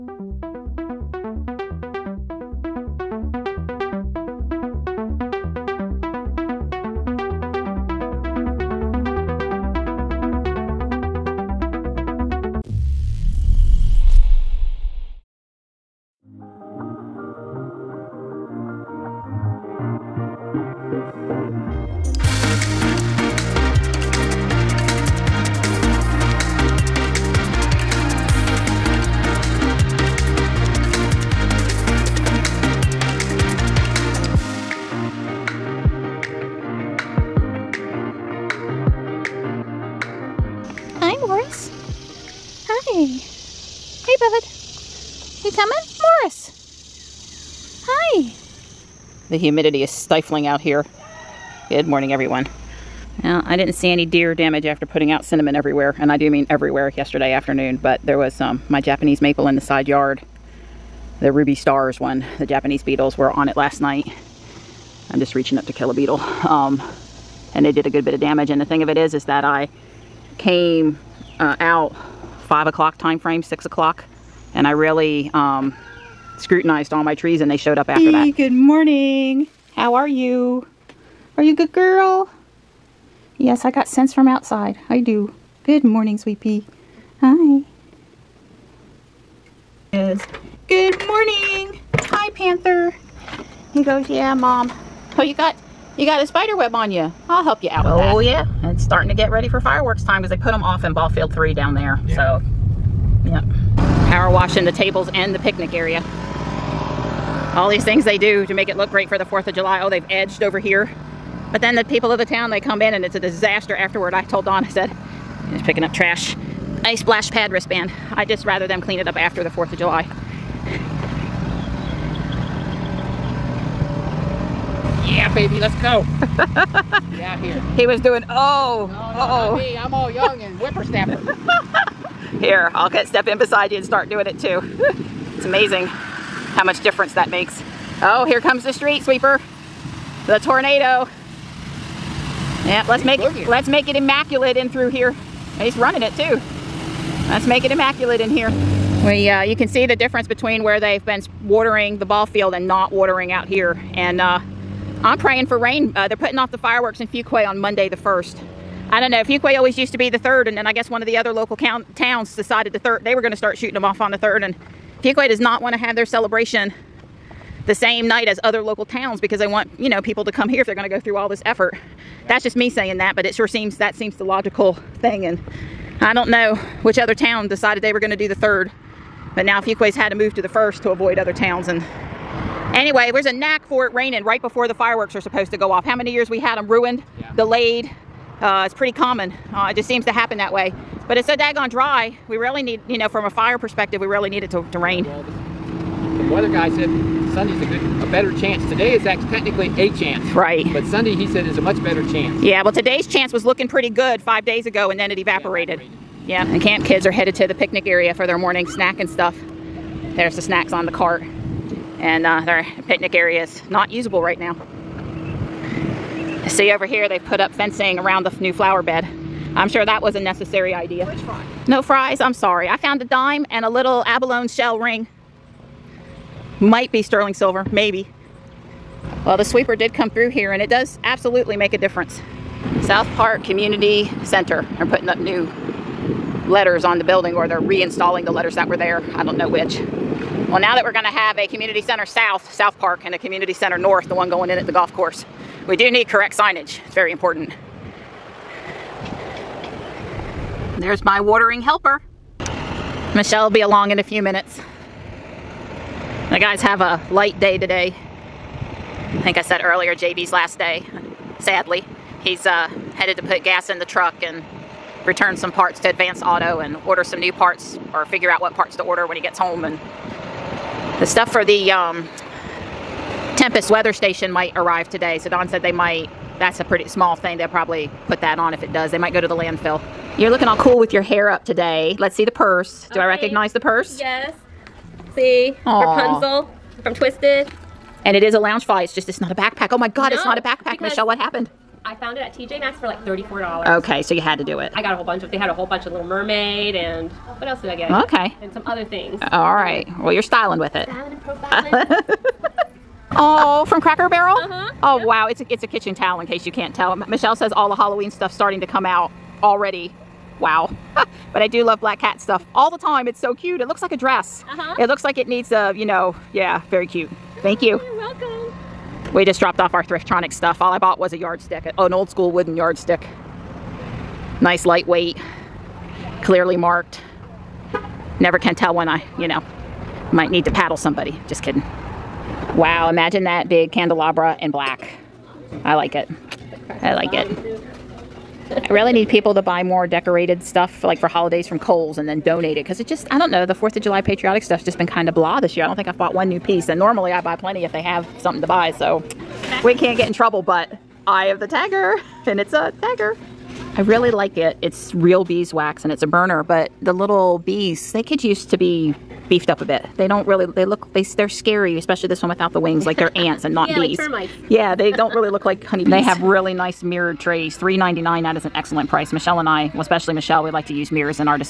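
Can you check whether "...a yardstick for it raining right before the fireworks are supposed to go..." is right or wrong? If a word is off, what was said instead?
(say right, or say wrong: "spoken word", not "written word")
wrong: "knack", not "yardstick".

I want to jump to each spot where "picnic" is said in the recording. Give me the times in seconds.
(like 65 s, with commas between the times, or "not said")
105 s, 207 s, 212 s.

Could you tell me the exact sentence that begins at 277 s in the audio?
They'll probably put that on if it does.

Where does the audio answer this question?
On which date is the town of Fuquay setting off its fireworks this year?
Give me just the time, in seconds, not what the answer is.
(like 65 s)
157 s.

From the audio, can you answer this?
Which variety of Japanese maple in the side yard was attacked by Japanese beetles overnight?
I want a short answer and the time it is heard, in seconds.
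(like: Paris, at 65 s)
Ruby Stars, at 61 s.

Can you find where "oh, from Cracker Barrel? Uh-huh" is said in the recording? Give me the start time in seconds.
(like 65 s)
303 s.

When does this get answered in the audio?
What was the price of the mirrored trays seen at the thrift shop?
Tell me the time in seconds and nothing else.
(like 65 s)
367 s.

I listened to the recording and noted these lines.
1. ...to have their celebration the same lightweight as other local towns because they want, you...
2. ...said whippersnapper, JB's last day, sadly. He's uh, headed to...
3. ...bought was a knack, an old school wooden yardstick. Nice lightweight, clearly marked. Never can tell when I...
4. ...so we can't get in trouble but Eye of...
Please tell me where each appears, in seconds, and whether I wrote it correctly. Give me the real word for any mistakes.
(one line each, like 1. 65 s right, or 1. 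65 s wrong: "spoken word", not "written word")
1. 165 s wrong: "night", not "lightweight"
2. 259 s wrong: "earlier", not "whippersnapper"
3. 320 s wrong: "yardstick", not "knack"
4. 348 s right.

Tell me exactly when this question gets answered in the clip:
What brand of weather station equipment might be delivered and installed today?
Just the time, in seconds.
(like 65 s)
273 s.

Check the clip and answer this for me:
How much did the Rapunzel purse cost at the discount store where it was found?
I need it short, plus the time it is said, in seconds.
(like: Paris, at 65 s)
$34, at 293 s.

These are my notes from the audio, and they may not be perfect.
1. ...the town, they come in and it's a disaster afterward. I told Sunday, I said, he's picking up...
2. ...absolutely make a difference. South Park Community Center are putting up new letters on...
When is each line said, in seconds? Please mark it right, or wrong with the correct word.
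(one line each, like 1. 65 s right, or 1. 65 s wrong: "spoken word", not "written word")
1. 112 s wrong: "Don", not "Sunday"
2. 231 s right.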